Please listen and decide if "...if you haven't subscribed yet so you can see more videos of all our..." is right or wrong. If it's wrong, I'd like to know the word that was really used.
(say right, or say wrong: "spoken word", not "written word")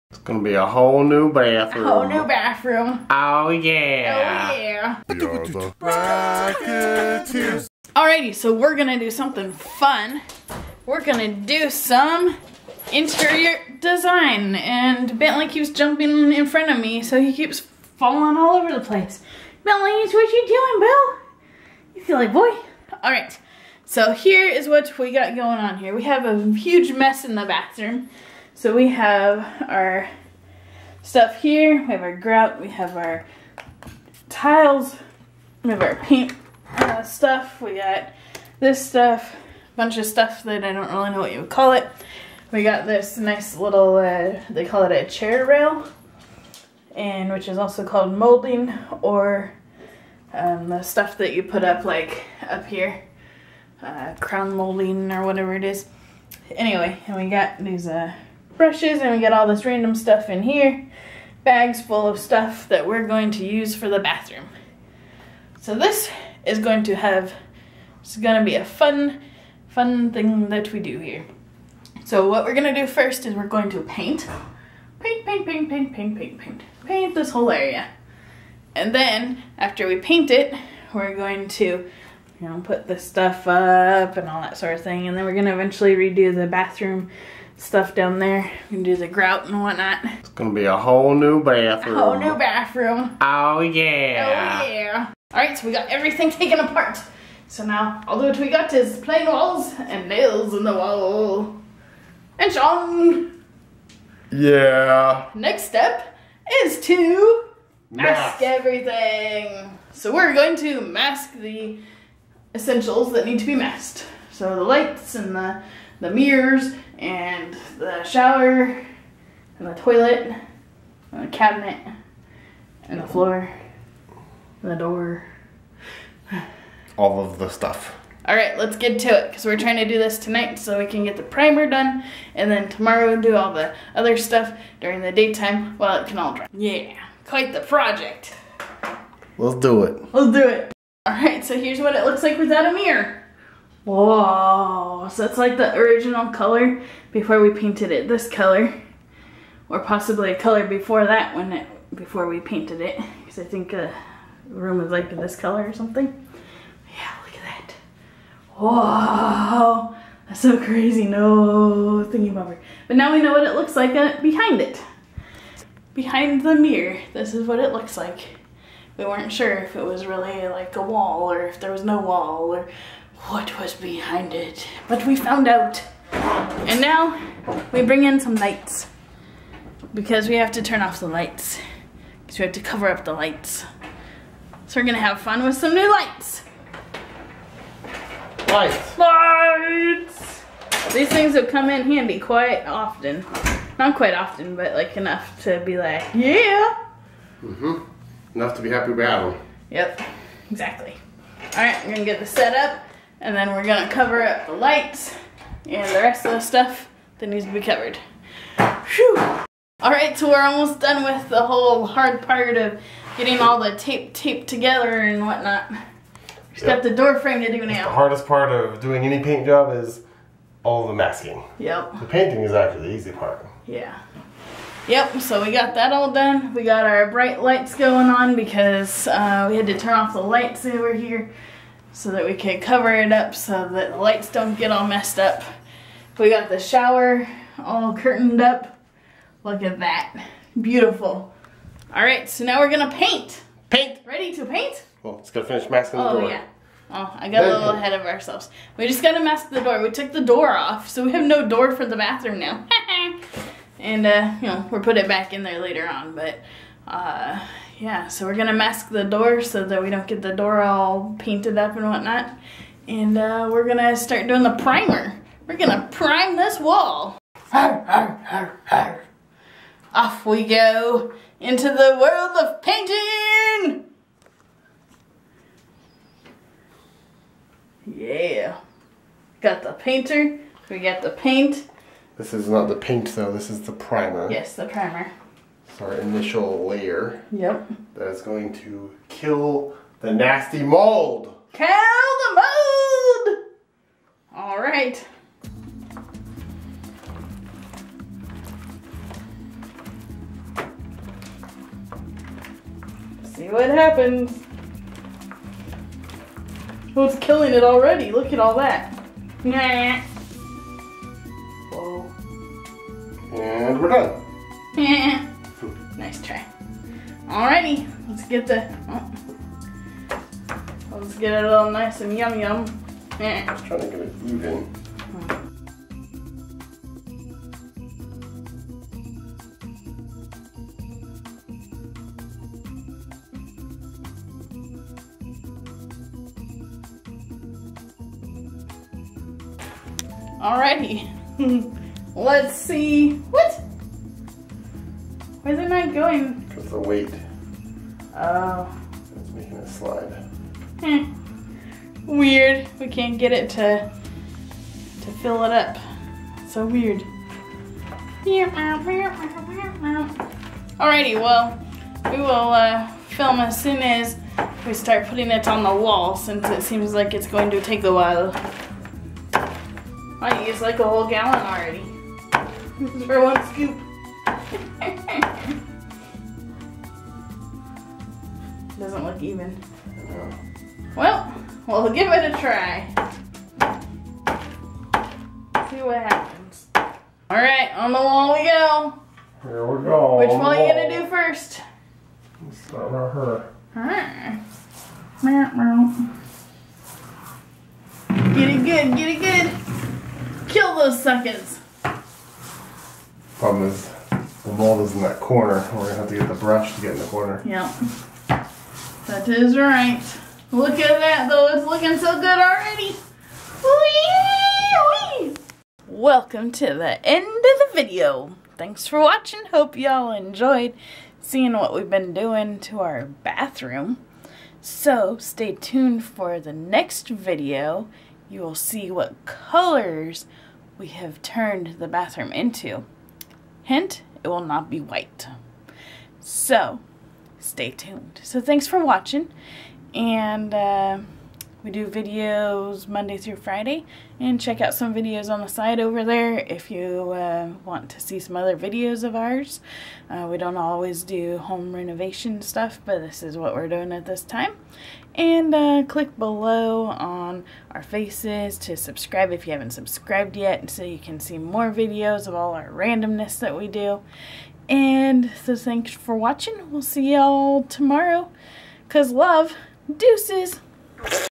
right.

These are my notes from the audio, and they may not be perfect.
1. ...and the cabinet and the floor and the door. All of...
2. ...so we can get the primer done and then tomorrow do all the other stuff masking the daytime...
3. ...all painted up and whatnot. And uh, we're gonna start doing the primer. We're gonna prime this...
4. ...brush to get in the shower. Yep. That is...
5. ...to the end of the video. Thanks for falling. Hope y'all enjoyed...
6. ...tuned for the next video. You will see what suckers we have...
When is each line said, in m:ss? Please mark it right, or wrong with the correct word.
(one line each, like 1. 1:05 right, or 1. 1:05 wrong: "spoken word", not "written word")
1. 2:01 right
2. 2:10 wrong: "during", not "masking"
3. 4:20 right
4. 6:46 wrong: "corner", not "shower"
5. 6:56 wrong: "watching", not "falling"
6. 7:05 wrong: "colors", not "suckers".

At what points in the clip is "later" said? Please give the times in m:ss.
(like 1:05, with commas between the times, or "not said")
4:15.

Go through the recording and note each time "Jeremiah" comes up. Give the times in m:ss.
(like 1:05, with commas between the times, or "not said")
not said.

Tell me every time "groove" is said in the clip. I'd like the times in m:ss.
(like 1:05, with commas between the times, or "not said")
not said.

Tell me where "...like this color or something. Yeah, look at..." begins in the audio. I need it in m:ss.
2:34.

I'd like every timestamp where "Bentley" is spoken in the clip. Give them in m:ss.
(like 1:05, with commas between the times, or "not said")
0:15, 0:19.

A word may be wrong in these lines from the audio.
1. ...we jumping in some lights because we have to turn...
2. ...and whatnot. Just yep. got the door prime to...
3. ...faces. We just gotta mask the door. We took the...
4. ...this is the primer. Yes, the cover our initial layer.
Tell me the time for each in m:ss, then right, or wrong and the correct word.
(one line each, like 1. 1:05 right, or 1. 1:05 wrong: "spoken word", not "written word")
1. 2:57 wrong: "bring", not "jumping"
2. 3:35 wrong: "frame", not "prime"
3. 4:08 wrong: "ourselves", not "faces"
4. 4:43 wrong: "primer", not "cover".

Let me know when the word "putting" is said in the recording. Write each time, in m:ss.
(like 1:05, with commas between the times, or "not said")
6:05.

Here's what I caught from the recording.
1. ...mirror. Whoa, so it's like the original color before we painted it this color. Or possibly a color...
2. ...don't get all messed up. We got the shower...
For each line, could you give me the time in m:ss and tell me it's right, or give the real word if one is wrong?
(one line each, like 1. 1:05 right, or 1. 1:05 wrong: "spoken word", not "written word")
1. 2:22 right
2. 3:54 right.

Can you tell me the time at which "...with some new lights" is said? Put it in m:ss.
3:05.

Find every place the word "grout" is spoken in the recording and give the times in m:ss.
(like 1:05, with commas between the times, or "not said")
0:32, 1:29.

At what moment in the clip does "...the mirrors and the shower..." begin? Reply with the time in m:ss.
1:56.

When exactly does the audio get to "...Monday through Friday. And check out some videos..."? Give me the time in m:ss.
7:22.